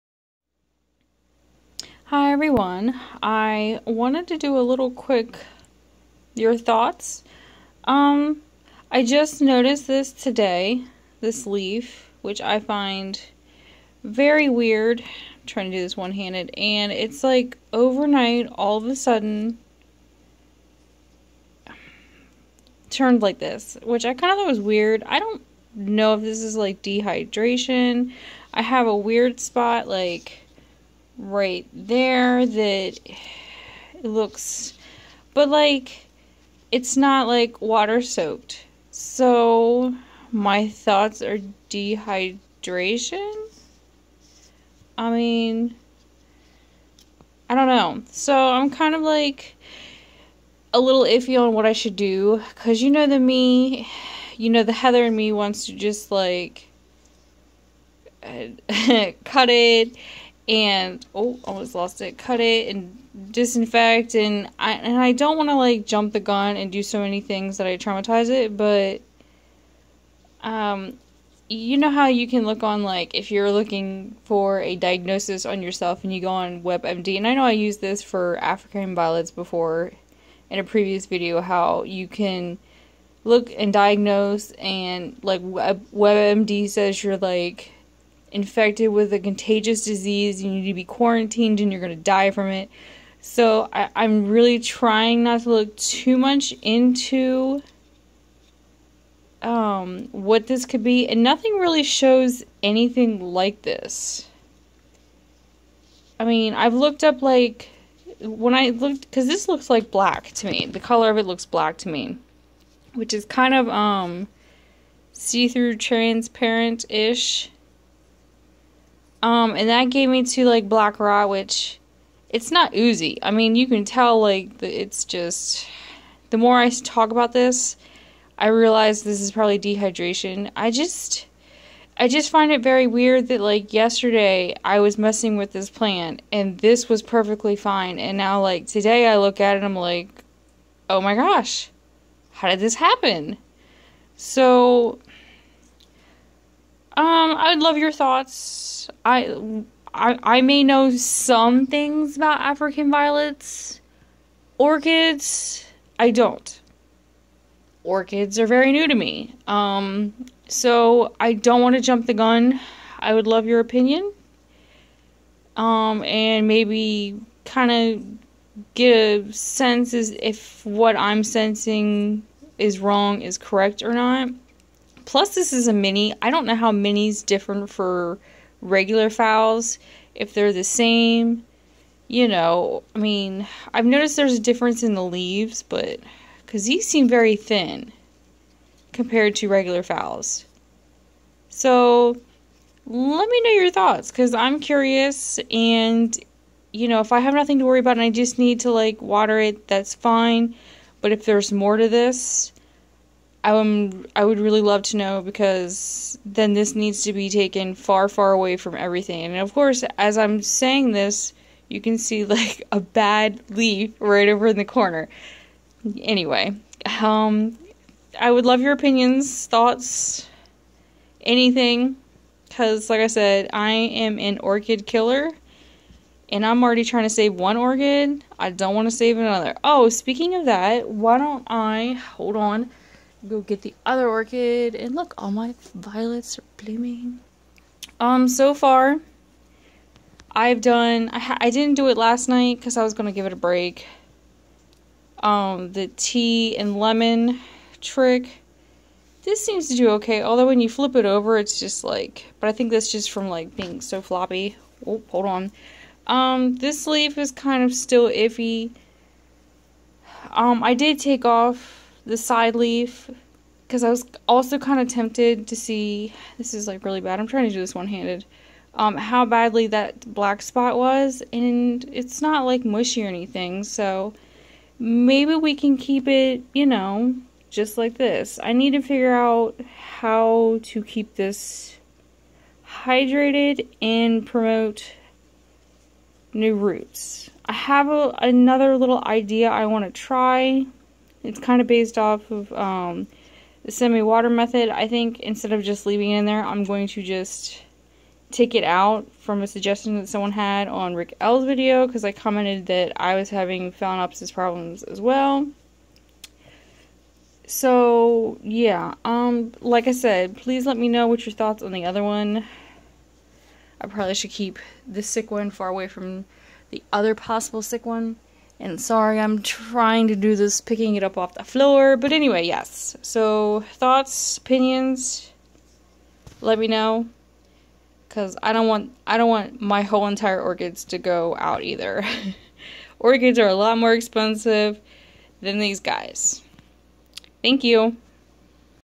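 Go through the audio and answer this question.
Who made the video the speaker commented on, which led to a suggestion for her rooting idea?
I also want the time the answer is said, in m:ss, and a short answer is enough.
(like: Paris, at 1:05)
Rick L, at 5:00.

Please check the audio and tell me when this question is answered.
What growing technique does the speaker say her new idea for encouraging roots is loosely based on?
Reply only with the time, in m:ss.
4:53.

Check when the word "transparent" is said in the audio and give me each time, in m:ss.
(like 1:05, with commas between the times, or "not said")
1:55.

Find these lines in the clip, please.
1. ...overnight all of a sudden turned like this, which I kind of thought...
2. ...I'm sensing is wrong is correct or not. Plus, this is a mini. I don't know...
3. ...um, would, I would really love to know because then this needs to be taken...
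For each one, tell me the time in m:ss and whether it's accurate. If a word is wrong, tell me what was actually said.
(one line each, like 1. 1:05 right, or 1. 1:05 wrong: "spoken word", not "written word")
1. 0:17 right
2. 2:50 right
3. 3:23 right.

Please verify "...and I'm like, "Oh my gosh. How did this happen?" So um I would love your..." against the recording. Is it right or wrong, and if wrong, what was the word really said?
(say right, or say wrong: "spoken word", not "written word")
right.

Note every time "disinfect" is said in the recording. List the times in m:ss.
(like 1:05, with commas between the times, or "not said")
1:03.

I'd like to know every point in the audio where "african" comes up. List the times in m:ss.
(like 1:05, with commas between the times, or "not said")
1:18, 2:32.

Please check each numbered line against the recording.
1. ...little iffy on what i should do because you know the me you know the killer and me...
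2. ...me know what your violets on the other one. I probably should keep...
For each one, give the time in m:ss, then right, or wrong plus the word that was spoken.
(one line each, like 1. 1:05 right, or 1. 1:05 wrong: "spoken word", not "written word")
1. 0:50 wrong: "heather", not "killer"
2. 5:10 wrong: "thoughts", not "violets".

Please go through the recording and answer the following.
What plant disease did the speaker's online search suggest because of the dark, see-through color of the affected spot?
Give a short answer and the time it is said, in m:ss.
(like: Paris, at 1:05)
Black Rot, at 2:00.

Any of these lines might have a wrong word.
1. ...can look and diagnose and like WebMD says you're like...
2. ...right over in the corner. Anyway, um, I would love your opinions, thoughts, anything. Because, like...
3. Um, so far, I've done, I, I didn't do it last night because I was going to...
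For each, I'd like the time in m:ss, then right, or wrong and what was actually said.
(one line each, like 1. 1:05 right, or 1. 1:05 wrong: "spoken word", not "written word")
1. 1:22 right
2. 3:33 right
3. 3:57 right.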